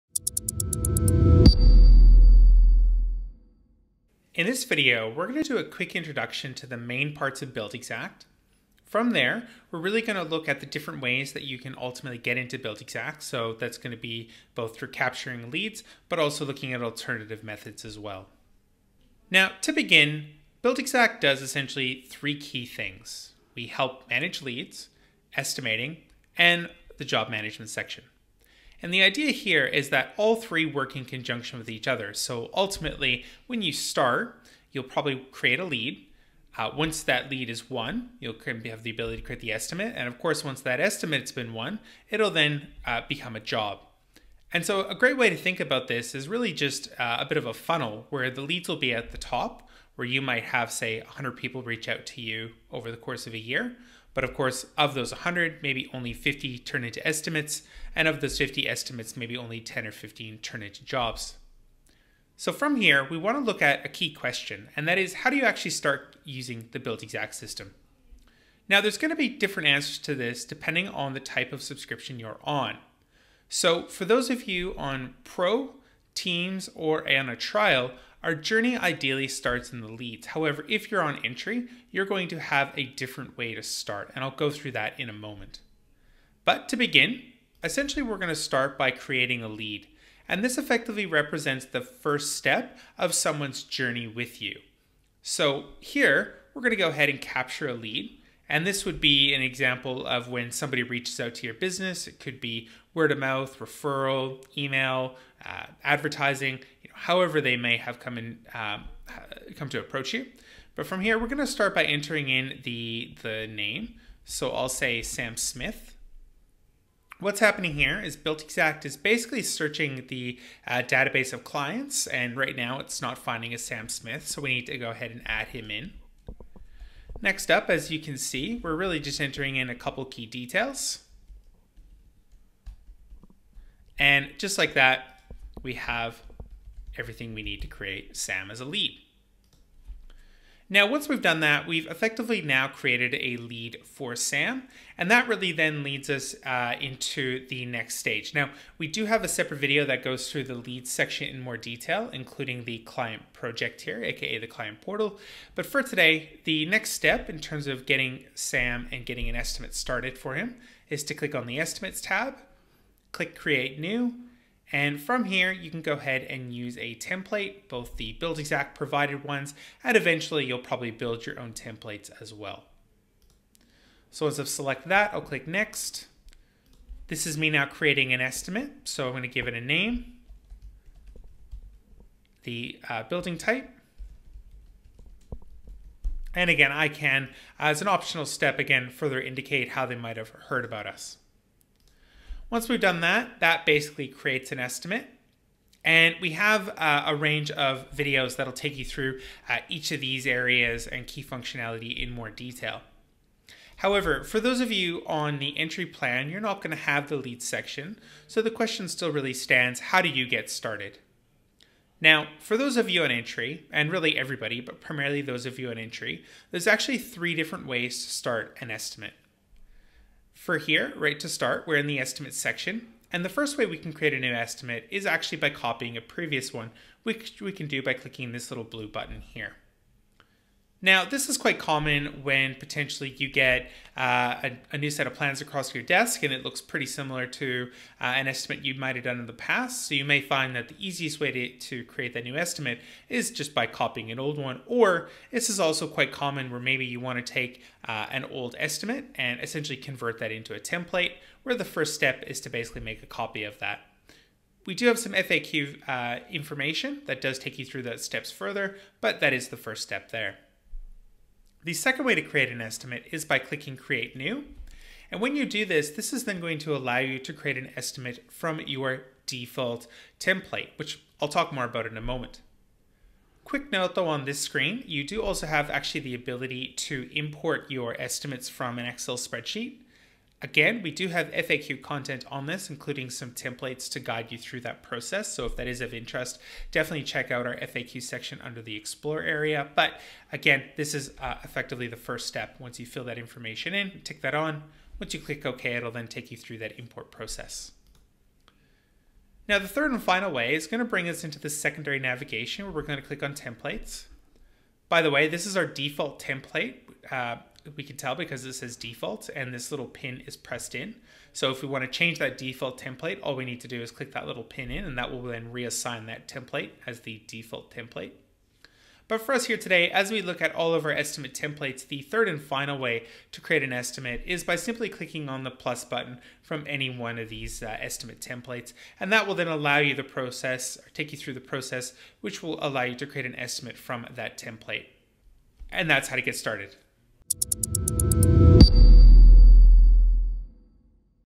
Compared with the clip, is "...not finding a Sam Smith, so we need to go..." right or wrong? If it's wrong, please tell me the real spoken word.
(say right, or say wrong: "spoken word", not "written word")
right.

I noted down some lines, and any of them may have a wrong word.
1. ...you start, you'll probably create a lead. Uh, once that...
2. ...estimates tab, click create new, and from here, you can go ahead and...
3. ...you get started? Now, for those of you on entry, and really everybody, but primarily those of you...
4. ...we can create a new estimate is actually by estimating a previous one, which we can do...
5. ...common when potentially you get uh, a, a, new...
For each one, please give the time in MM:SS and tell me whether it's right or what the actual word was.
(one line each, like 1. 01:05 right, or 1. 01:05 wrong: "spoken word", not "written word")
1. 00:33 right
2. 02:41 right
3. 03:30 right
4. 03:43 wrong: "copying", not "estimating"
5. 03:51 right.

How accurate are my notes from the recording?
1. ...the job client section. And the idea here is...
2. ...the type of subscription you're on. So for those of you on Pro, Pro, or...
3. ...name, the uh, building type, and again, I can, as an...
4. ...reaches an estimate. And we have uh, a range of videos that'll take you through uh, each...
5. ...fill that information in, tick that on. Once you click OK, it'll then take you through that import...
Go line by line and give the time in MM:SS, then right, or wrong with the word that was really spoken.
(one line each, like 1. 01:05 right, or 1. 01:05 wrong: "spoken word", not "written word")
1. 00:26 wrong: "management", not "client"
2. 01:11 wrong: "Teams", not "Pro"
3. 02:59 right
4. 03:14 wrong: "creates", not "reaches"
5. 04:52 right.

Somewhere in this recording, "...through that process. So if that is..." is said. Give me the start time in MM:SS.
04:44.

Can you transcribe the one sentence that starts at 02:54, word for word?
So as I've select that, I'll click next.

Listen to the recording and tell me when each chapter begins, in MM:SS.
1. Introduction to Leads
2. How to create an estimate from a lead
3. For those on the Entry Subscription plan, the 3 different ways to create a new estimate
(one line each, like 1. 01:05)
1. 01:26
2. 02:43
3. 03:24.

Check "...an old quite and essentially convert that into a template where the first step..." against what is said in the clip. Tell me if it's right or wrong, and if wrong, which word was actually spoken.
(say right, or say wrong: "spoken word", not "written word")
wrong: "estimate", not "quite".